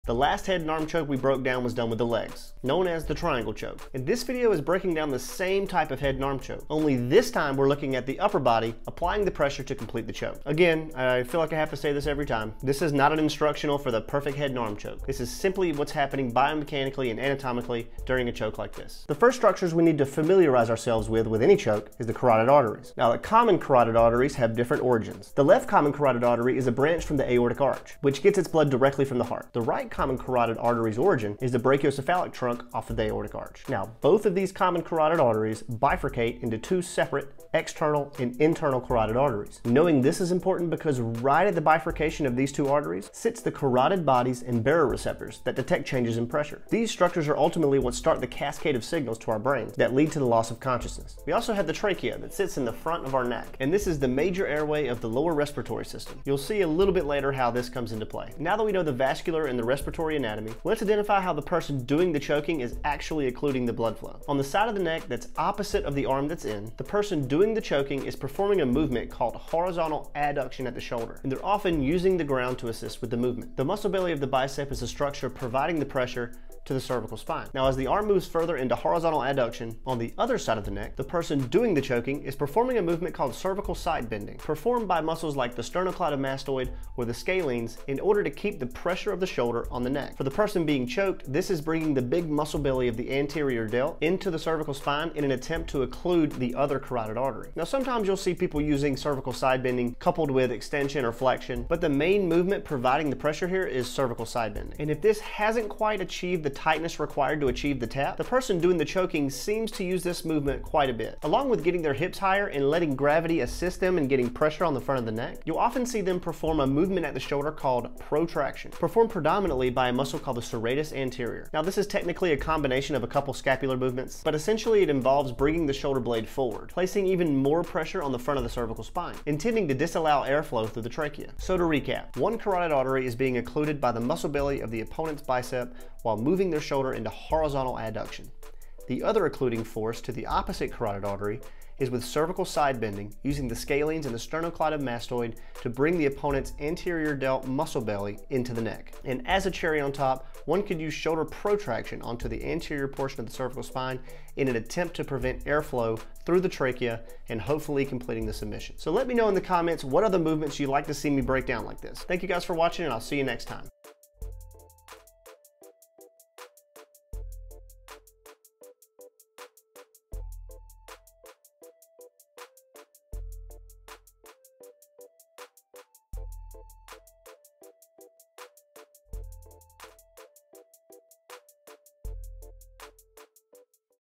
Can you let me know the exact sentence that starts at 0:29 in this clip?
The right common carotid artery's origin is the brachiocephalic trunk off of the aortic arch.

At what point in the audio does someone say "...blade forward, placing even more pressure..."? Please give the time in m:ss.
2:05.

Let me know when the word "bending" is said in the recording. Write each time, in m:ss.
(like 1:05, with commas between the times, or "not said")
1:24, 1:39, 1:44, 2:22.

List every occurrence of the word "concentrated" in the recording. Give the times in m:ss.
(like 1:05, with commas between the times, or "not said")
not said.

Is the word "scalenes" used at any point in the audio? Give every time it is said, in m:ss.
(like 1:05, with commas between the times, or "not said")
1:27, 2:23.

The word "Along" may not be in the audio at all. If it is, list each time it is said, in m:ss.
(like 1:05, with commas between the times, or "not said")
1:51.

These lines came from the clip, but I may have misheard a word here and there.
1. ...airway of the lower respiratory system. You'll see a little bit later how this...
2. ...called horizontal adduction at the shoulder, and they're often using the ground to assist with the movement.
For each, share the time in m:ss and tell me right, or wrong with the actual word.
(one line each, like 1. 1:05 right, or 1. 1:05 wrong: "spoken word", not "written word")
1. 0:54 right
2. 1:09 right.